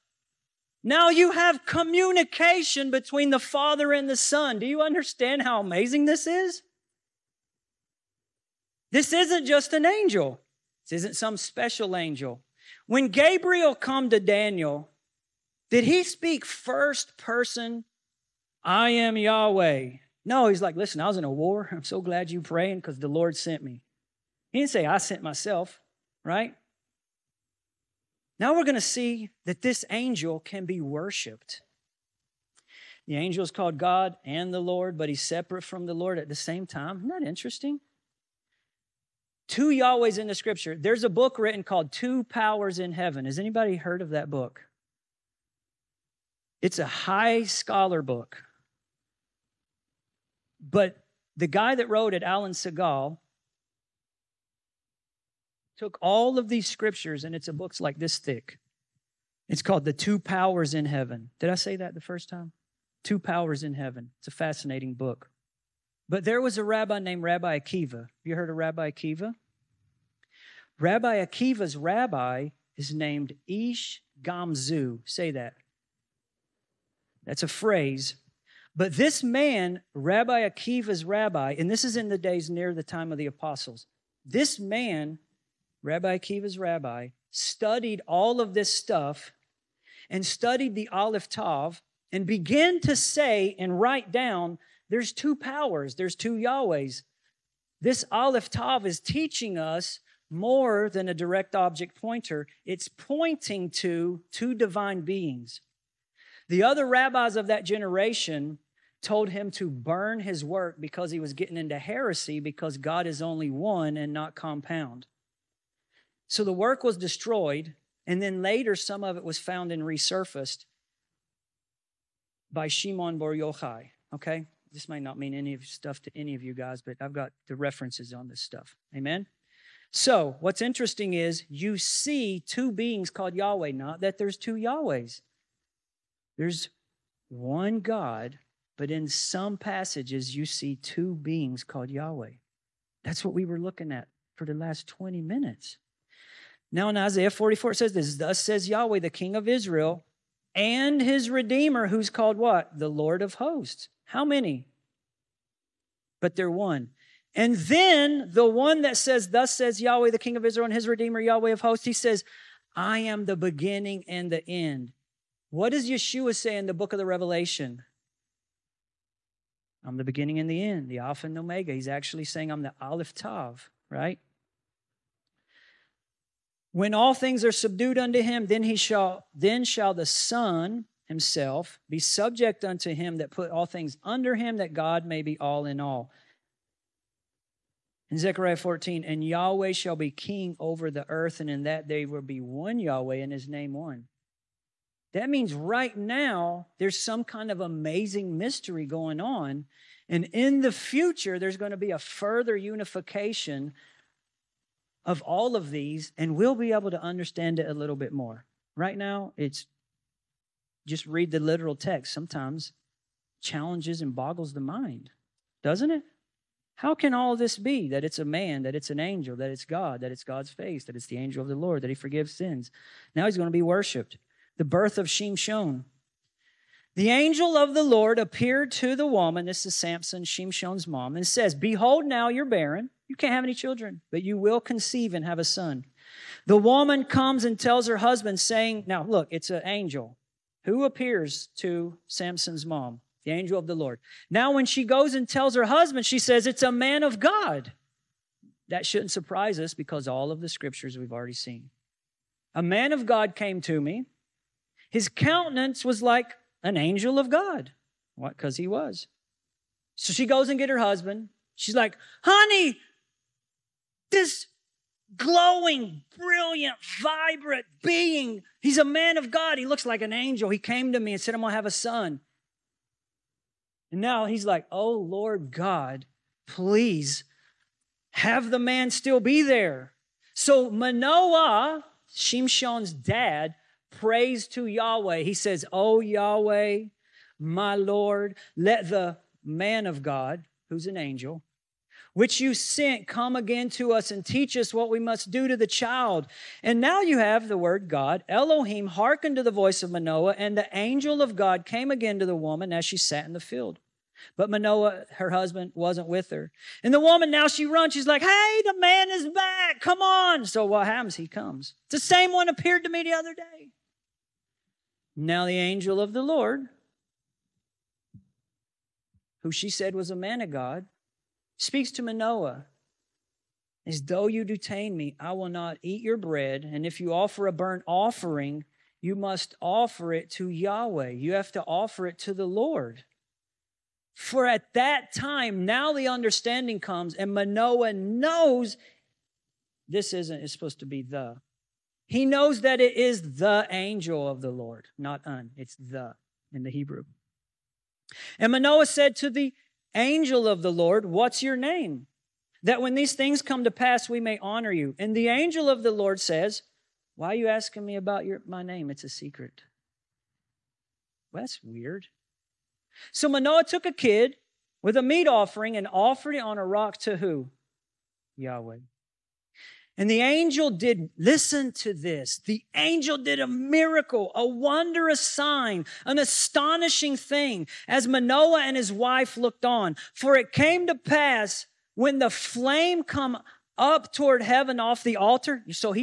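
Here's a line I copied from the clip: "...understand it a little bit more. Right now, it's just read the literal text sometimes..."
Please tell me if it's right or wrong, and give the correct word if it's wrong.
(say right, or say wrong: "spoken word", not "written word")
right.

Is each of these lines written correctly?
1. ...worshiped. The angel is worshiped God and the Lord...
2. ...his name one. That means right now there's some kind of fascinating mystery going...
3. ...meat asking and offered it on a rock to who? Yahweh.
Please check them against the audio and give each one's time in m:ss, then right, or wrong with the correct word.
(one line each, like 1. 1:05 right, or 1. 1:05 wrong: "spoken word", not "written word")
1. 0:30 wrong: "called", not "worshiped"
2. 3:13 wrong: "amazing", not "fascinating"
3. 6:05 wrong: "offering", not "asking".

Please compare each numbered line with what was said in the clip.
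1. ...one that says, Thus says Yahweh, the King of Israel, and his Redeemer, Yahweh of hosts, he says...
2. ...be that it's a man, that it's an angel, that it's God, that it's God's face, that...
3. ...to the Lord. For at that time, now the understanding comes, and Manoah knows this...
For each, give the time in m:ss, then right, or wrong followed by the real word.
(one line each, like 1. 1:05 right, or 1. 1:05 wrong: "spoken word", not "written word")
1. 2:38 right
2. 3:37 right
3. 5:32 right.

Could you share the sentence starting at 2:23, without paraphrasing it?
That's what we were looking at for the last 20 minutes.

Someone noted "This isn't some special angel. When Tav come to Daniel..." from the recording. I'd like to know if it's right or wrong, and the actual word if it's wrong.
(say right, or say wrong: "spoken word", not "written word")
wrong: "Gabriel", not "Tav".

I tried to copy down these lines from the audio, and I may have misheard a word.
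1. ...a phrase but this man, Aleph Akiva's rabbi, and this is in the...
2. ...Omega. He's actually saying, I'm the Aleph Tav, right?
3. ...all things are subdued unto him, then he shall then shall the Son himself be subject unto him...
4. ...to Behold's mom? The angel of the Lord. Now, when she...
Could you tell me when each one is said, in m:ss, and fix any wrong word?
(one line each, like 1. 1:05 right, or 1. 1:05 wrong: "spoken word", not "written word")
1. 1:17 wrong: "Rabbi", not "Aleph"
2. 2:51 right
3. 2:56 right
4. 4:01 wrong: "Samson", not "Behold".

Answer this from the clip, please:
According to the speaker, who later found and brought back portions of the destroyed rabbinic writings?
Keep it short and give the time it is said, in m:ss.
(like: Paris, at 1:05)
Shimon Bar Yochai, at 2:02.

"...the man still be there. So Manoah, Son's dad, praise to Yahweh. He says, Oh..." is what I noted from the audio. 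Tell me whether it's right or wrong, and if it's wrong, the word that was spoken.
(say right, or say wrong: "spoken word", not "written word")
wrong: "Shimshon", not "Son".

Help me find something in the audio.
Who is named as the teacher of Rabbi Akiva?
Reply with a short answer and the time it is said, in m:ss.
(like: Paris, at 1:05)
Ish Gamzu, at 1:13.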